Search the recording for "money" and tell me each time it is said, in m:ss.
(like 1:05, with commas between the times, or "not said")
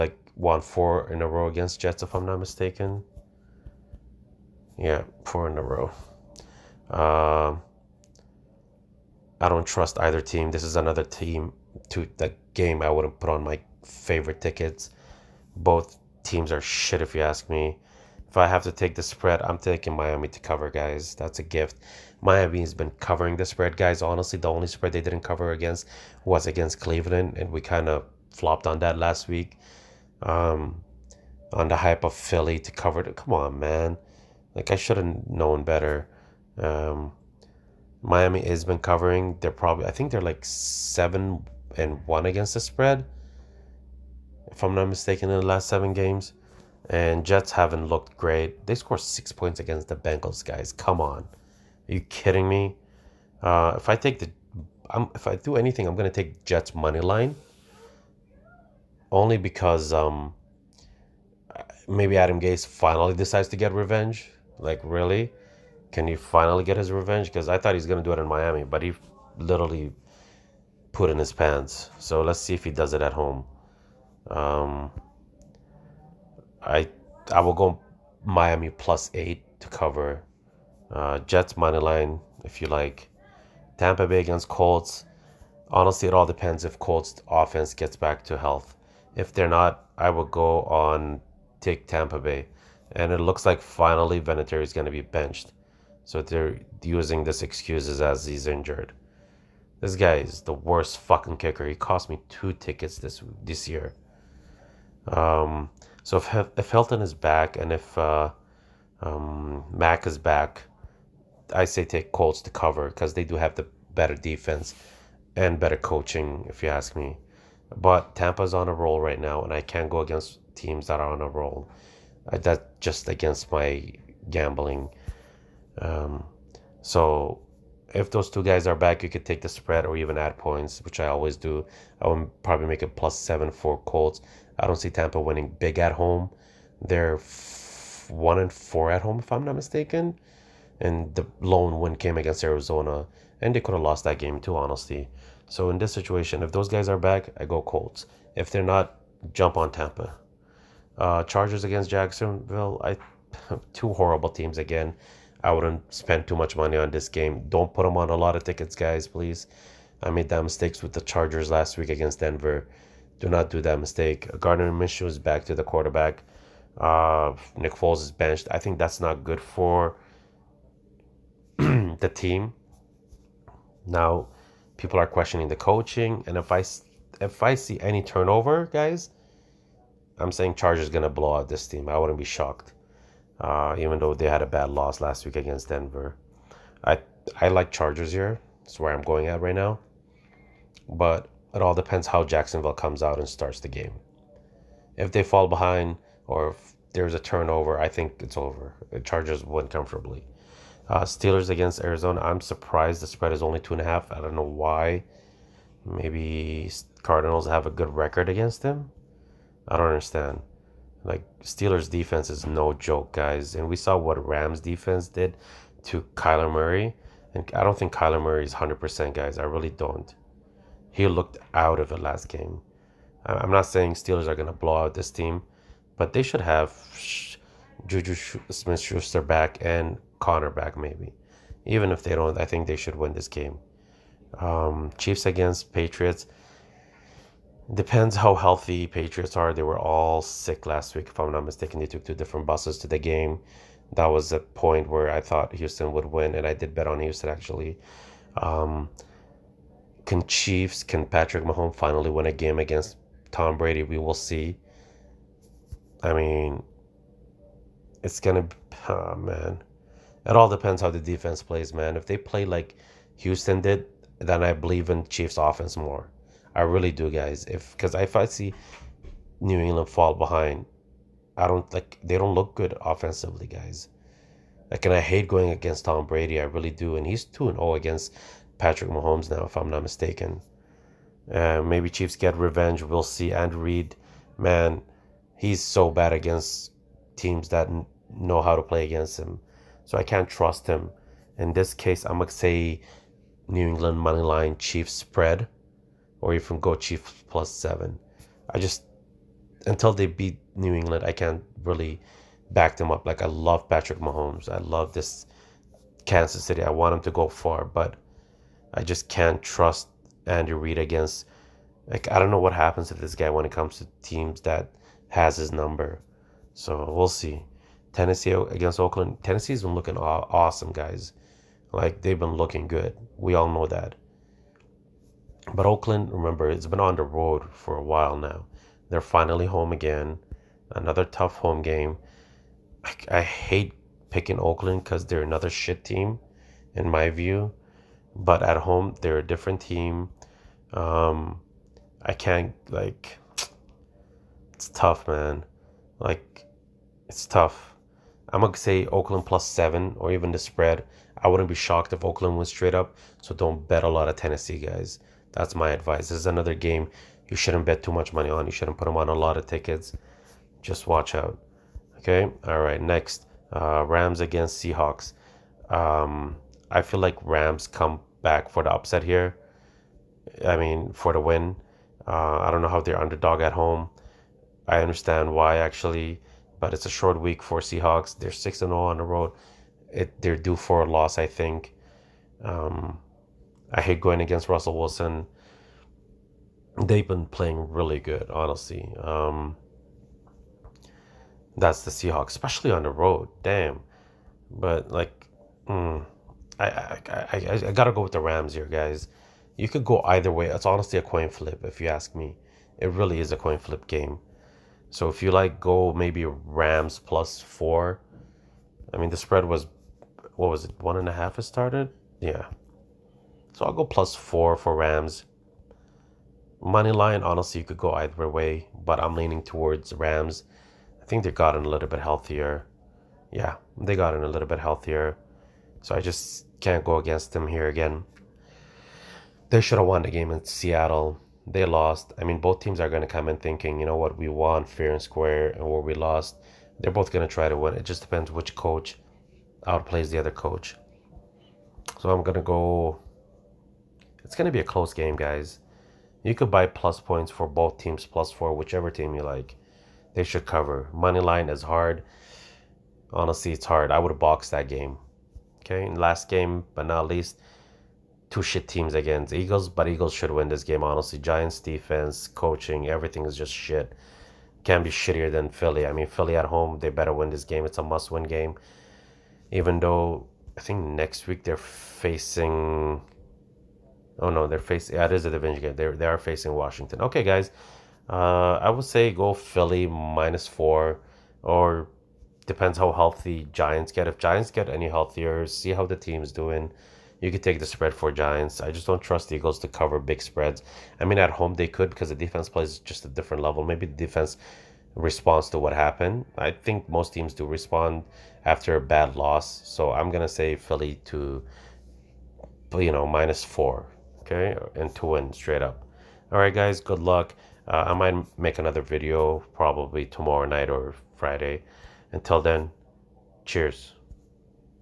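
0:56, 1:21, 2:36, 4:53, 5:58, 6:56, 7:30.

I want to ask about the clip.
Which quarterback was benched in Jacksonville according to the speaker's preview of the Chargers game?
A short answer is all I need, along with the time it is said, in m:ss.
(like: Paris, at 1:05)
Nick Foles, at 2:47.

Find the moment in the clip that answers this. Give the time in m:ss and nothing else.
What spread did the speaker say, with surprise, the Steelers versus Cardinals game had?
3:23.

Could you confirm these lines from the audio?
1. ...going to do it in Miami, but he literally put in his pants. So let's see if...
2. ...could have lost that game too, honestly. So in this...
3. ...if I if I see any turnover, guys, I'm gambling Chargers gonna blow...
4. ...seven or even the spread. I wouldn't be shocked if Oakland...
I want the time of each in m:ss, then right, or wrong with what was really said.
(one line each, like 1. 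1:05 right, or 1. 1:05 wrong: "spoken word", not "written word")
1. 1:07 right
2. 2:23 right
3. 2:56 wrong: "saying", not "gambling"
4. 5:49 right.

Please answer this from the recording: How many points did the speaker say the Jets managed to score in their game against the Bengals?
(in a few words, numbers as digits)
6.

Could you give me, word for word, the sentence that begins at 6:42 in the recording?
It really is a coin flip game.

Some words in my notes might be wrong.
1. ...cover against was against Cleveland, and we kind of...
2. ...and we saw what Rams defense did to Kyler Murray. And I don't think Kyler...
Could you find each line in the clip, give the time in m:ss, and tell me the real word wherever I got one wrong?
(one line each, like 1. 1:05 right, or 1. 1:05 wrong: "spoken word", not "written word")
1. 0:25 right
2. 3:33 right.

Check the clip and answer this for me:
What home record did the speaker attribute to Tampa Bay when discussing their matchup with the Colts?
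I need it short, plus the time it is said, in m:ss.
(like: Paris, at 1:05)
1 and 4, at 2:18.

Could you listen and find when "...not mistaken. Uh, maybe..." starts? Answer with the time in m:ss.
4:39.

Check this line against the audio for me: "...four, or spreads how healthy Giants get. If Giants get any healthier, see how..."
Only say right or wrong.
wrong.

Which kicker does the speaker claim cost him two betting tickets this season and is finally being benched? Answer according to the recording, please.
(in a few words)
Vinatieri.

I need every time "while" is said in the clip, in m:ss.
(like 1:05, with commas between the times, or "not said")
5:27.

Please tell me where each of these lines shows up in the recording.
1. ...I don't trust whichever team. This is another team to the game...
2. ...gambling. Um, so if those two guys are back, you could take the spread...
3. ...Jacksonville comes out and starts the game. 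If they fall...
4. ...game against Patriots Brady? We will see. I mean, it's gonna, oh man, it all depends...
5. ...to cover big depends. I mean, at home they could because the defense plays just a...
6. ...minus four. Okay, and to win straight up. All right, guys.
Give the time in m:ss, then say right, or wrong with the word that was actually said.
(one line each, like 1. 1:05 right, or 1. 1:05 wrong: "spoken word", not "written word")
1. 0:09 wrong: "either", not "whichever"
2. 2:04 right
3. 3:12 right
4. 4:12 wrong: "Tom", not "Patriots"
5. 8:09 wrong: "spreads", not "depends"
6. 8:23 right.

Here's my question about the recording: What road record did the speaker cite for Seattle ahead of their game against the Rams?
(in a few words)
6 and 0.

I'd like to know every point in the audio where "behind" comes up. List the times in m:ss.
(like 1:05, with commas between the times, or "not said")
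3:15, 4:30.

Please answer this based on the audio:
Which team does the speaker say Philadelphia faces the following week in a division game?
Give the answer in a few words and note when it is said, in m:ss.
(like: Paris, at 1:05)
Washington, at 7:56.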